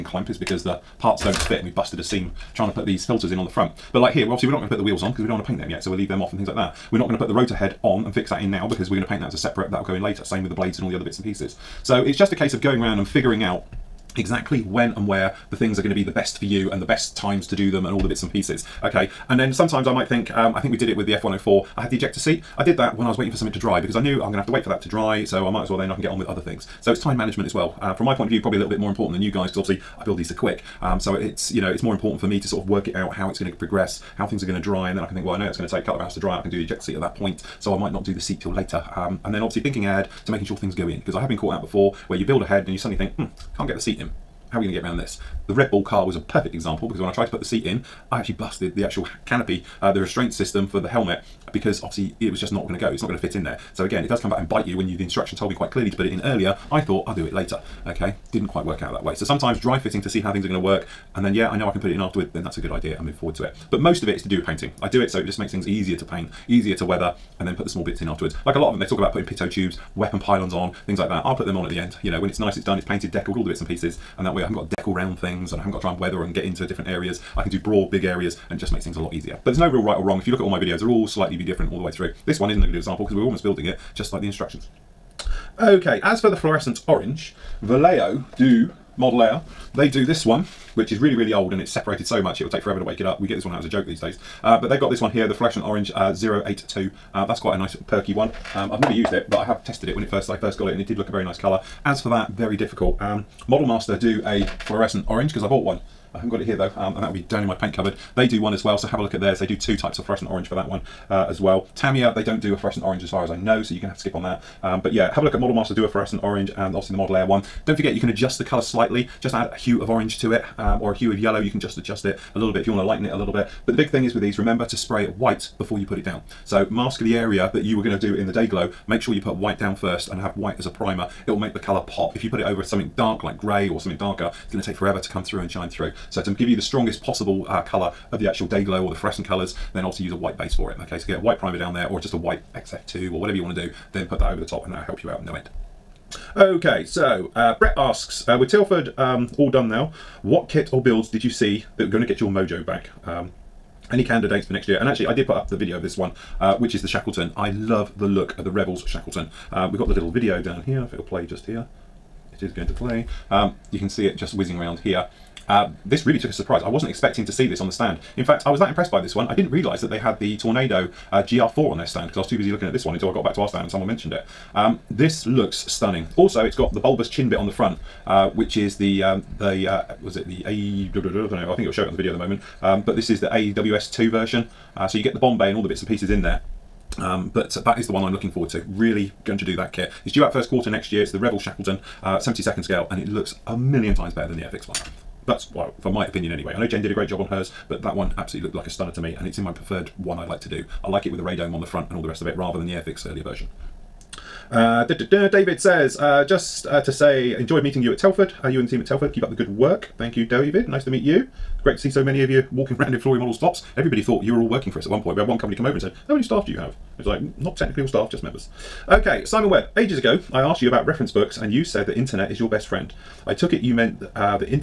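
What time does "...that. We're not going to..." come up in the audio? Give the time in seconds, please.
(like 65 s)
6 s.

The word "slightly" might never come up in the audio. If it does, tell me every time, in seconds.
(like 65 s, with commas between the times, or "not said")
81 s, 118 s.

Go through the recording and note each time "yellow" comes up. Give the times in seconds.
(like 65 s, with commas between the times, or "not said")
121 s.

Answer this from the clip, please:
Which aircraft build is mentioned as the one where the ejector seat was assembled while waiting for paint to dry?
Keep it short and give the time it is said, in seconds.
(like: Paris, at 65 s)
F104, at 21 s.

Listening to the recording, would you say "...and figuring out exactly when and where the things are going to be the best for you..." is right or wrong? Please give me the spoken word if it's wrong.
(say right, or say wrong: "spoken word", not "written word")
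right.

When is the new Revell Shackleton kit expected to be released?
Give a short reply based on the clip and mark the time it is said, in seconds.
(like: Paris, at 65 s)
First quarter next year, at 190 s.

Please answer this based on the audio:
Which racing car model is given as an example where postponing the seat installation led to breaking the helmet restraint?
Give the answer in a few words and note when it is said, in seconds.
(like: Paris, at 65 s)
Red Bull car, at 45 s.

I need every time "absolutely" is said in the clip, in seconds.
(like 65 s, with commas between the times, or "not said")
198 s.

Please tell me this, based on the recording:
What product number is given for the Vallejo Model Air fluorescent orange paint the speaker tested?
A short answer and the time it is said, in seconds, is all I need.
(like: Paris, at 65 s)
082, at 96 s.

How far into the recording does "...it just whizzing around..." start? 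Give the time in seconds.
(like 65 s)
164 s.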